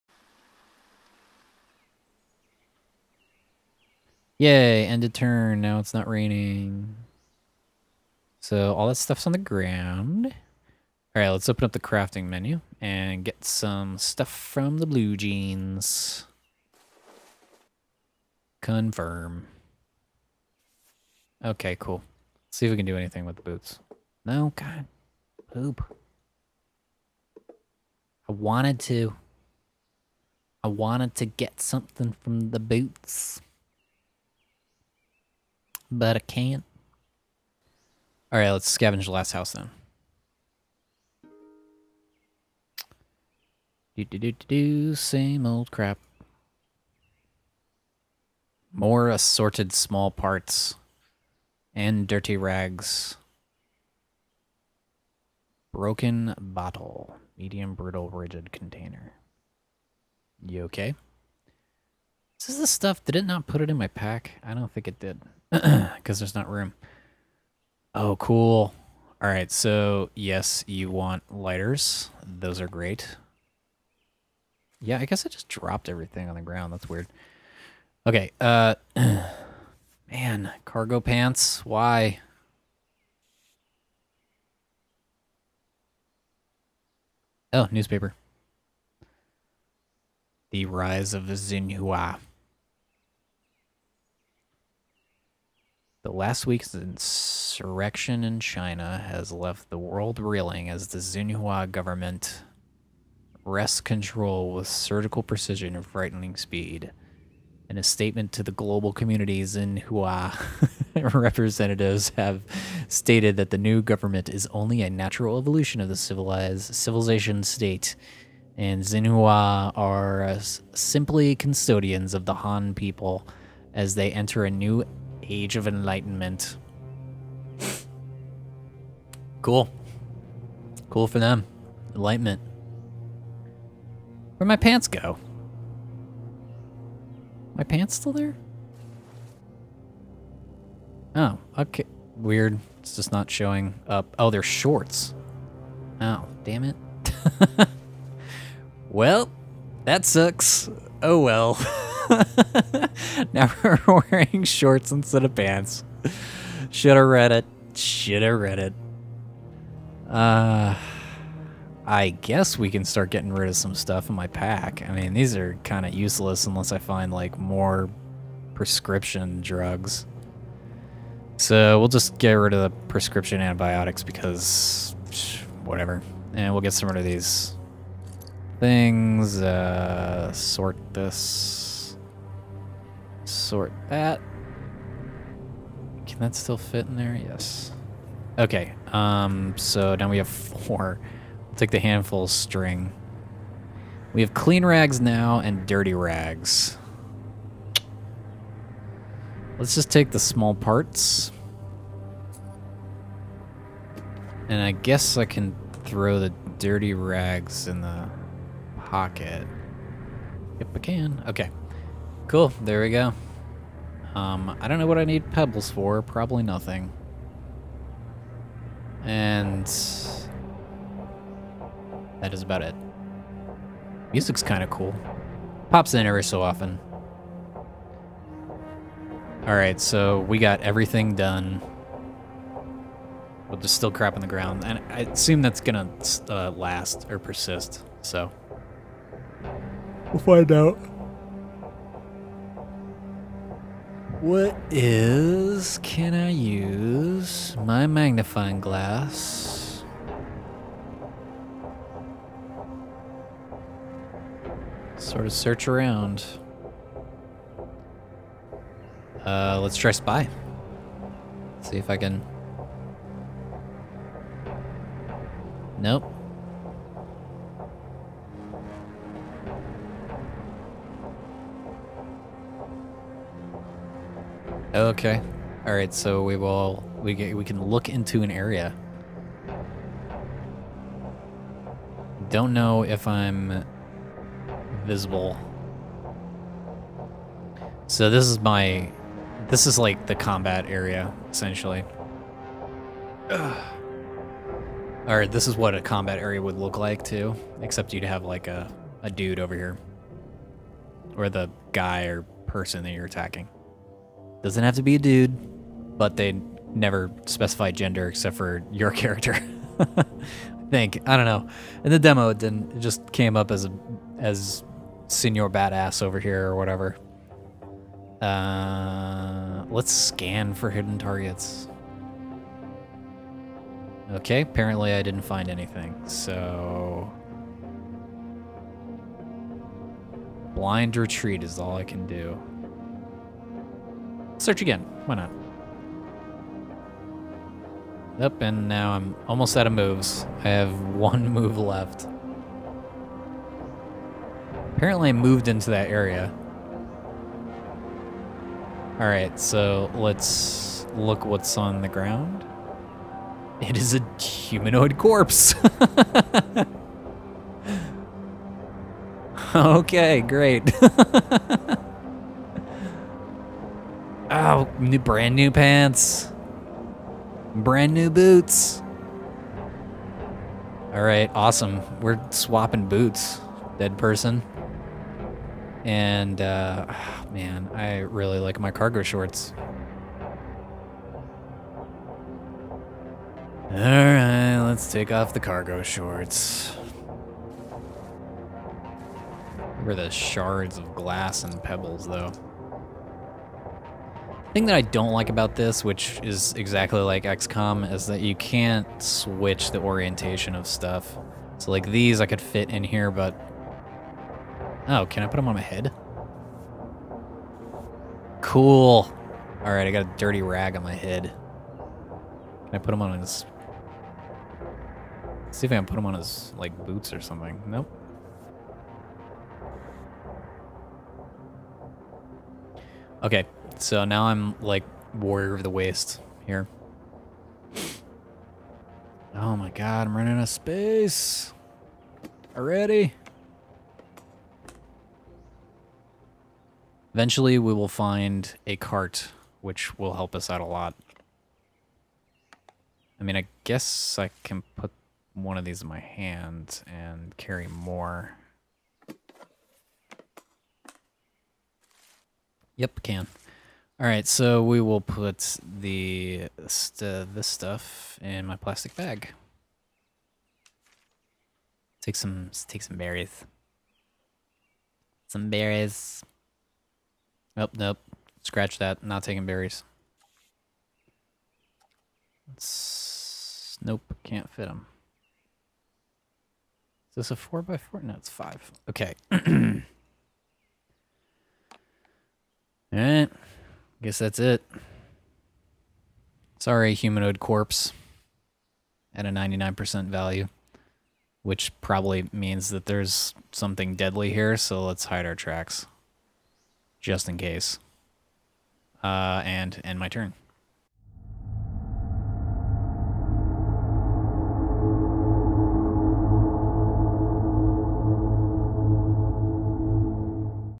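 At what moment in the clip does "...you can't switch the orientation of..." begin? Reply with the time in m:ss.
6:38.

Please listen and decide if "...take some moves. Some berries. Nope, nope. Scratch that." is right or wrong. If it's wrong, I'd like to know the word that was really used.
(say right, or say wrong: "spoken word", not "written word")
wrong: "berries", not "moves".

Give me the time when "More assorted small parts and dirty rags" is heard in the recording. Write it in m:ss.
0:48.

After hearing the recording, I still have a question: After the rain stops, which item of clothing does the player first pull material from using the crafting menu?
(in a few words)
blue jeans.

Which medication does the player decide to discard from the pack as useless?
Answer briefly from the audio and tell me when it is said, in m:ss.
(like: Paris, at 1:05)
prescription antibiotics, at 2:52.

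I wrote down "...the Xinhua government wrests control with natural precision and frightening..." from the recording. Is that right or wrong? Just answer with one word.
wrong.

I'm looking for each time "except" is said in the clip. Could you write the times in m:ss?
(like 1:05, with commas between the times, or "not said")
4:57, 5:08.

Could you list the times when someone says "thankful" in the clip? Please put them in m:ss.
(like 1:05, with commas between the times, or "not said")
not said.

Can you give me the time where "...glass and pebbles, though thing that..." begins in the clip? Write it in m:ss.
6:30.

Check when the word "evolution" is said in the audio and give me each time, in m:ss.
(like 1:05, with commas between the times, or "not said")
1:55.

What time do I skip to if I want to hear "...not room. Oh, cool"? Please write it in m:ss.
1:06.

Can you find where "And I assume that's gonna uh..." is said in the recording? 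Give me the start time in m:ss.
3:54.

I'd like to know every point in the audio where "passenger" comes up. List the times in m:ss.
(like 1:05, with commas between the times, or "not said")
not said.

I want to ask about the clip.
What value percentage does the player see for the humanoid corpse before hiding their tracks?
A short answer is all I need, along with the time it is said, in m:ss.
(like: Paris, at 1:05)
99%, at 8:09.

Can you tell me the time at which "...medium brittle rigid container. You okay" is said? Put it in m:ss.
0:57.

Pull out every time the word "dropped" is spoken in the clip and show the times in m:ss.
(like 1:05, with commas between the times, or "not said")
1:15.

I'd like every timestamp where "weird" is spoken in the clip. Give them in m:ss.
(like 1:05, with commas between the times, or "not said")
1:16, 2:22.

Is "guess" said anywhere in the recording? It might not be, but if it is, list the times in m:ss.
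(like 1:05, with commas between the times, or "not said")
1:15, 2:42, 3:24, 7:23, 8:04.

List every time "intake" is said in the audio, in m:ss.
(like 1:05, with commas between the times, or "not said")
not said.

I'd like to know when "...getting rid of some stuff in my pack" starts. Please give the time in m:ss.
2:43.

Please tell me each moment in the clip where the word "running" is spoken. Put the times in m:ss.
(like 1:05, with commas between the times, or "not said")
7:10.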